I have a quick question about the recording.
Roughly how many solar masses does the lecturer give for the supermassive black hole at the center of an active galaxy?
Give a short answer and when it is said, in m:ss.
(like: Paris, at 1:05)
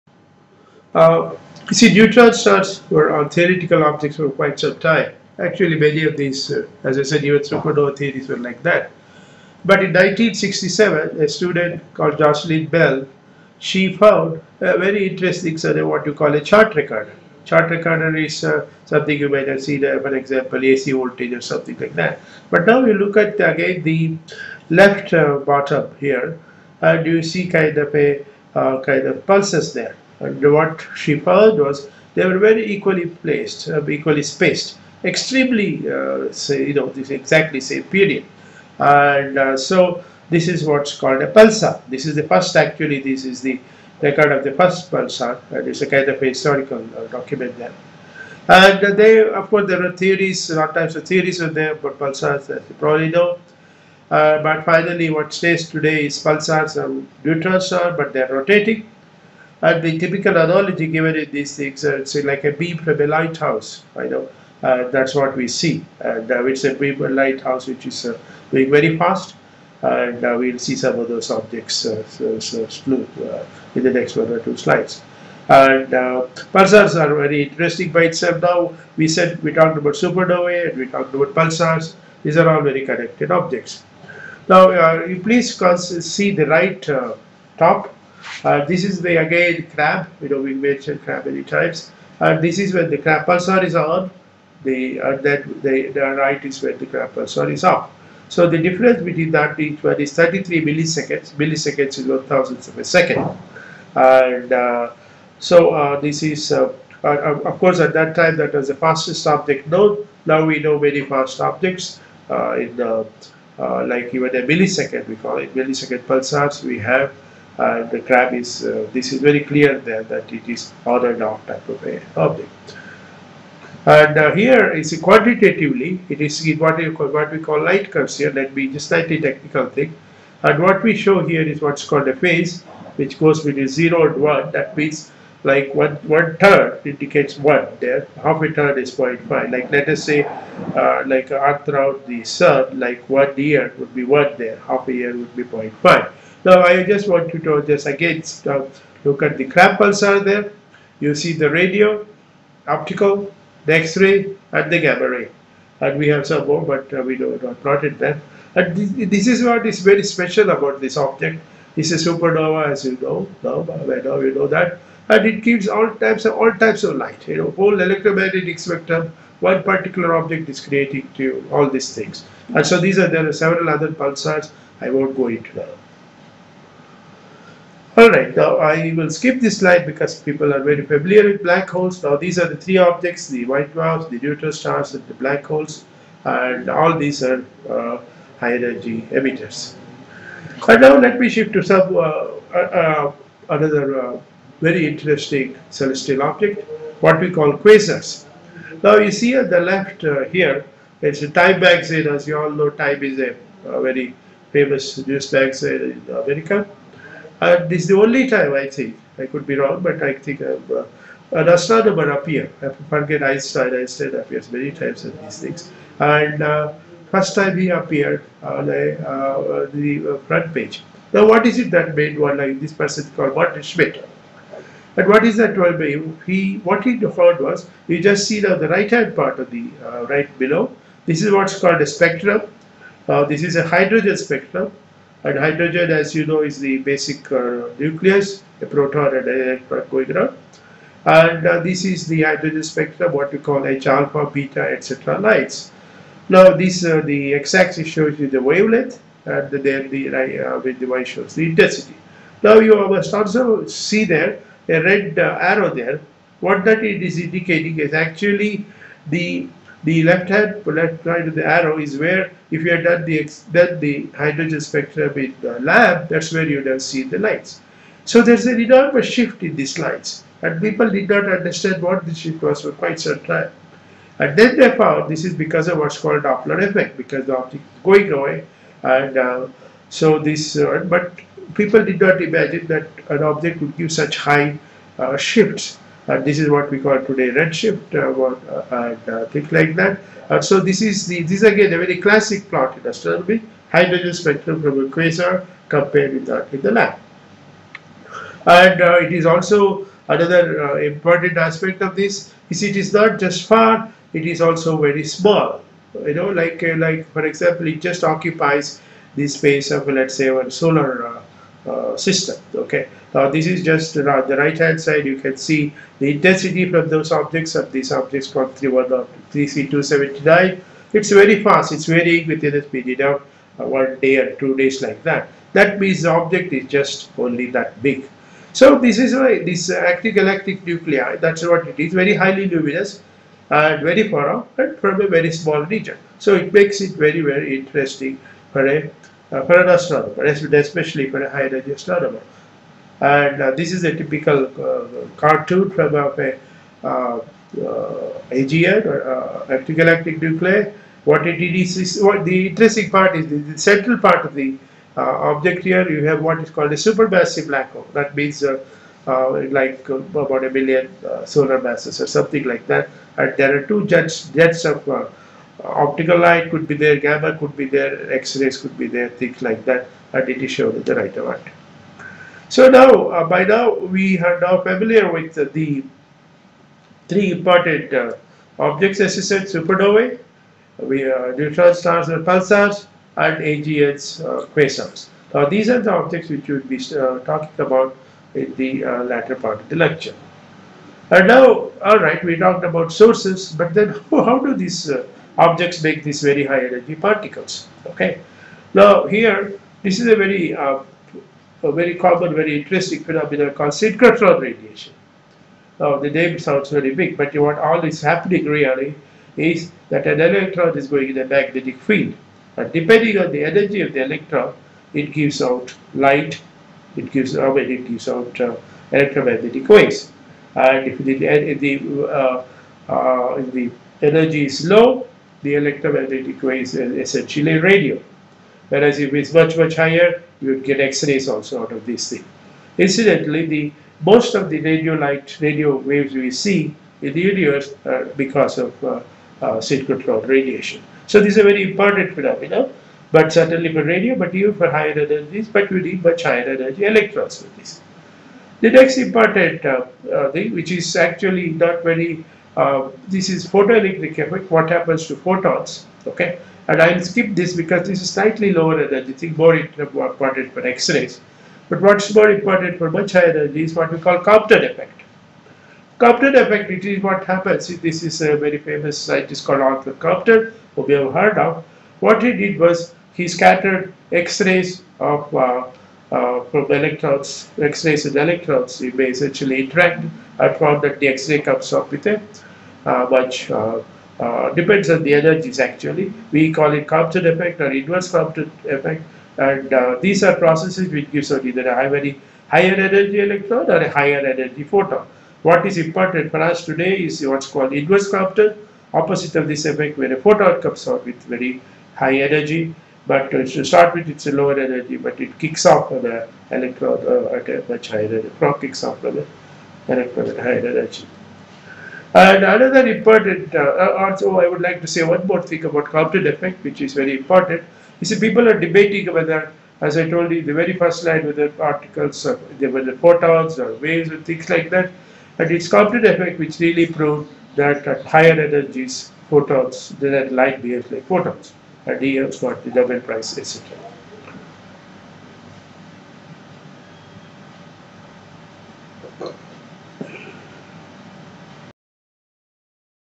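a million, at 6:00.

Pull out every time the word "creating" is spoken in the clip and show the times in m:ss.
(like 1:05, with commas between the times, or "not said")
2:50.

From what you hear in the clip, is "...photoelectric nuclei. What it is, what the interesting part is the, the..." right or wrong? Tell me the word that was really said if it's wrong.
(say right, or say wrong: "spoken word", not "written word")
wrong: "galactic", not "photoelectric".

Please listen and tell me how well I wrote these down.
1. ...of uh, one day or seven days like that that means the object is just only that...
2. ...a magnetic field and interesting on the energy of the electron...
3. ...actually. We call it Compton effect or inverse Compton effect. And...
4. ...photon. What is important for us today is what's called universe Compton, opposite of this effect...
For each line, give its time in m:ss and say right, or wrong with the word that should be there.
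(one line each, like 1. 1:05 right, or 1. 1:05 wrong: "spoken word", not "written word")
1. 5:23 wrong: "two", not "seven"
2. 6:51 wrong: "depending", not "interesting"
3. 8:05 right
4. 8:14 wrong: "inverse", not "universe".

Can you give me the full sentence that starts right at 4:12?
Now, you must also see there a red uh, arrow there.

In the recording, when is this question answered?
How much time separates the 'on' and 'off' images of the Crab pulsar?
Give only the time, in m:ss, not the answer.
1:40.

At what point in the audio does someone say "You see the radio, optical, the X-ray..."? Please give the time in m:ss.
2:30.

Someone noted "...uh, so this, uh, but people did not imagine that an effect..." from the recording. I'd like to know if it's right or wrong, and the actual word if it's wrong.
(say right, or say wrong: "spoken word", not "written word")
wrong: "object", not "effect".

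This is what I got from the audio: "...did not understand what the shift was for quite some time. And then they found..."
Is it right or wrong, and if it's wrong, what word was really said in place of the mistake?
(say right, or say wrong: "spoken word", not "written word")
right.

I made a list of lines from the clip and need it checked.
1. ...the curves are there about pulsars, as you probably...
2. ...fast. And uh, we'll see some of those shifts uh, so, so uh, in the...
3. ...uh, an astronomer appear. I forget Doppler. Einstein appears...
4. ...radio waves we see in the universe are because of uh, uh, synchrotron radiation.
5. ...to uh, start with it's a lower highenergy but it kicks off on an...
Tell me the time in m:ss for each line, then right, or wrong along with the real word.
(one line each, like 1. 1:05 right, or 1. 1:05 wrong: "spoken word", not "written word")
1. 0:50 wrong: "theories", not "curves"
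2. 1:08 wrong: "objects", not "shifts"
3. 3:31 wrong: "Einstein", not "Doppler"
4. 7:15 right
5. 8:23 wrong: "energy", not "highenergy".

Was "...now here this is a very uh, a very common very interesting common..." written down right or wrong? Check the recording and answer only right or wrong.
wrong.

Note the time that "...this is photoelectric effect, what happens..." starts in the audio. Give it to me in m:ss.
7:33.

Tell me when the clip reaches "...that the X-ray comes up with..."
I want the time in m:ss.
8:00.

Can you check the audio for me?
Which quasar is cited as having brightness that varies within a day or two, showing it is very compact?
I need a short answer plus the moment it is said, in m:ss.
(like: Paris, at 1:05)
3C279, at 5:18.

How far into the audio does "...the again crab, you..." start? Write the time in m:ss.
1:29.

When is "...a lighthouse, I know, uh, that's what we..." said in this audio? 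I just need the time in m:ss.
1:02.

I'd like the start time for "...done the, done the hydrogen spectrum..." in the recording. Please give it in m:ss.
4:22.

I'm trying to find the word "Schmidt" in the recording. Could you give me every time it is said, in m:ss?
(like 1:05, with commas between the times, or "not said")
3:43.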